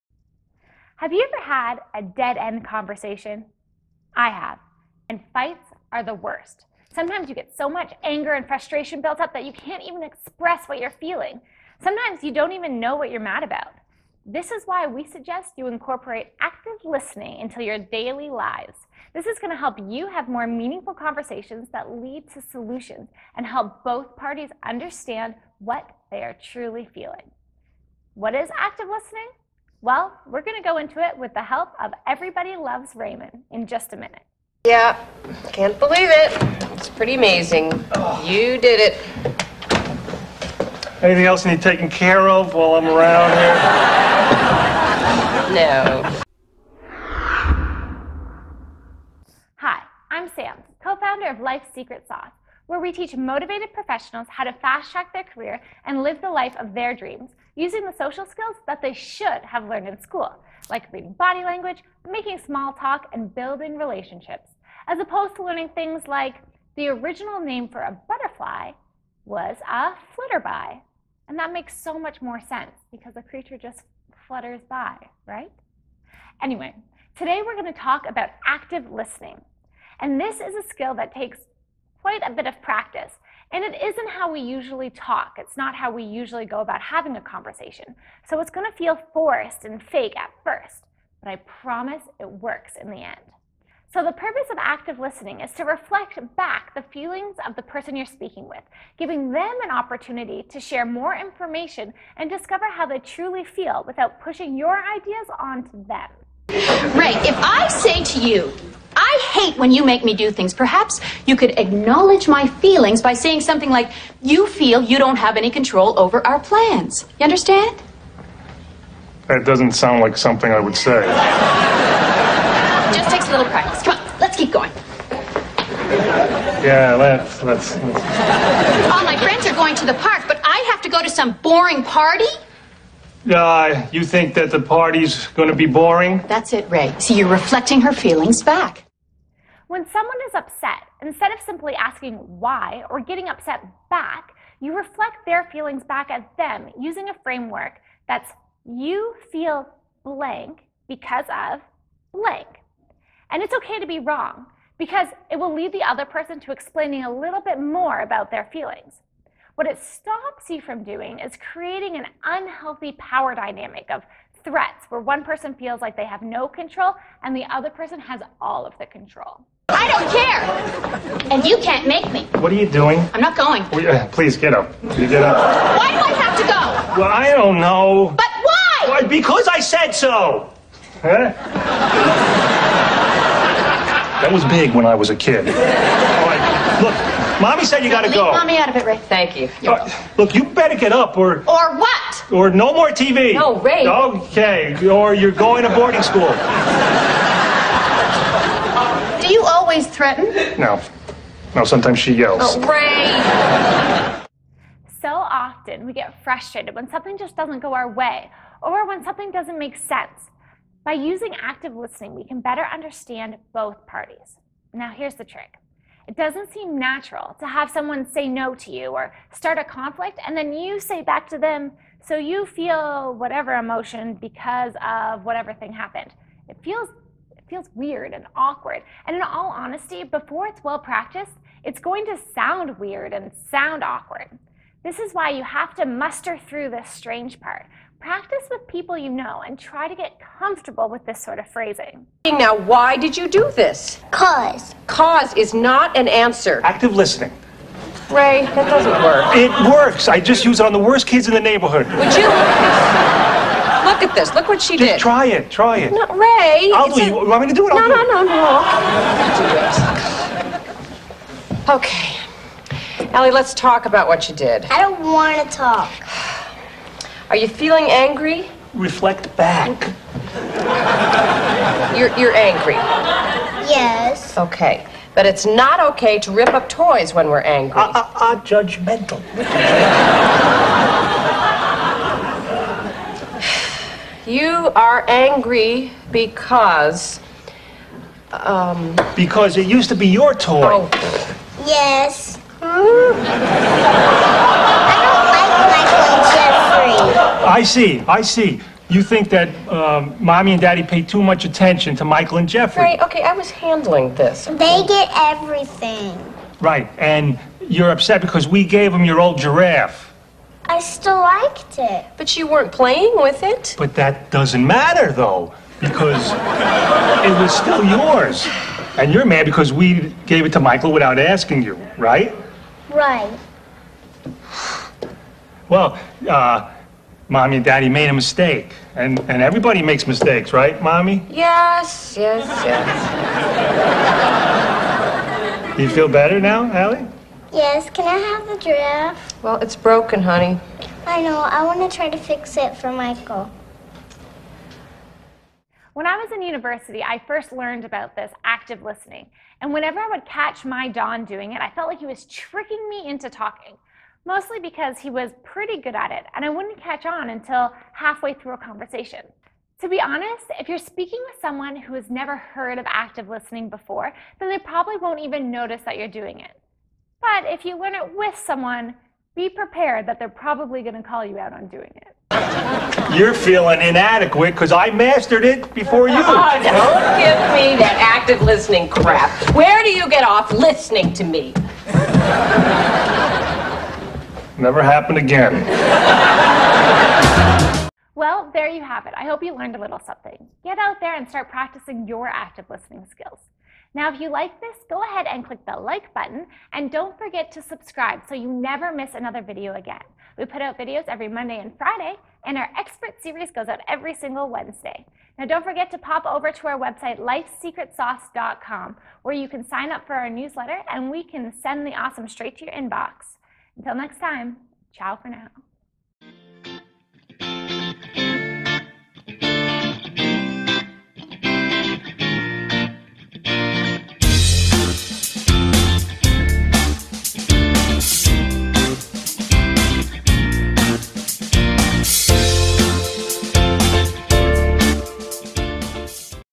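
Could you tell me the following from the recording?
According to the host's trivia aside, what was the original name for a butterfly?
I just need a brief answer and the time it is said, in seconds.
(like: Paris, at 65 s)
flitterby, at 70 s.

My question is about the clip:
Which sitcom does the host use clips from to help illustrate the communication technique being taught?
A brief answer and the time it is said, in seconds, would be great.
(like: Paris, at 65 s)
Everybody Loves Raymond, at 32 s.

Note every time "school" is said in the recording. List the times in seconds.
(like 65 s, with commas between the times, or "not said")
60 s, 196 s.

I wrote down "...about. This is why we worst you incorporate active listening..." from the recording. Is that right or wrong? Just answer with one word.
wrong.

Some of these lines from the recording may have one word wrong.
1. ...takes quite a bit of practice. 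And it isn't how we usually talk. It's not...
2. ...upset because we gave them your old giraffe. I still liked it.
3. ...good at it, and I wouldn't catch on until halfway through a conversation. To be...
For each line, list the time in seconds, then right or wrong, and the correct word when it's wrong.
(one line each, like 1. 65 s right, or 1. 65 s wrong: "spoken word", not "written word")
1. 81 s right
2. 307 s right
3. 355 s right.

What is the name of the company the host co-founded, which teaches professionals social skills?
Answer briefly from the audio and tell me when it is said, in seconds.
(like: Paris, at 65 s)
Life Secret Sauce, at 51 s.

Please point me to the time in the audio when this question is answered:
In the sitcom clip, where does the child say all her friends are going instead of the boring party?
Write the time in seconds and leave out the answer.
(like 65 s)
129 s.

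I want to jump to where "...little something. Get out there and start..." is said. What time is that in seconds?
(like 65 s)
389 s.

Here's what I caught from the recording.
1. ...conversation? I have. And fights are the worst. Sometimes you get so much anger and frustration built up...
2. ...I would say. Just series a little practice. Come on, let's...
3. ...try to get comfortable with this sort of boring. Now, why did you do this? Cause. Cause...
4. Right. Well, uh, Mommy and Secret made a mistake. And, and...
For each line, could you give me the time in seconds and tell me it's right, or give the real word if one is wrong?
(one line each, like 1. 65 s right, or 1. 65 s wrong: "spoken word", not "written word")
1. 2 s right
2. 120 s wrong: "takes", not "series"
3. 239 s wrong: "phrasing", not "boring"
4. 322 s wrong: "Daddy", not "Secret".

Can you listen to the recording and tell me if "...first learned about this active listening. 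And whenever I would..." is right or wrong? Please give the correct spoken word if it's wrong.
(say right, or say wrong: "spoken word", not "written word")
right.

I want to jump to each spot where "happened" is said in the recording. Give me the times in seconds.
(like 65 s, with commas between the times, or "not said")
225 s, 384 s.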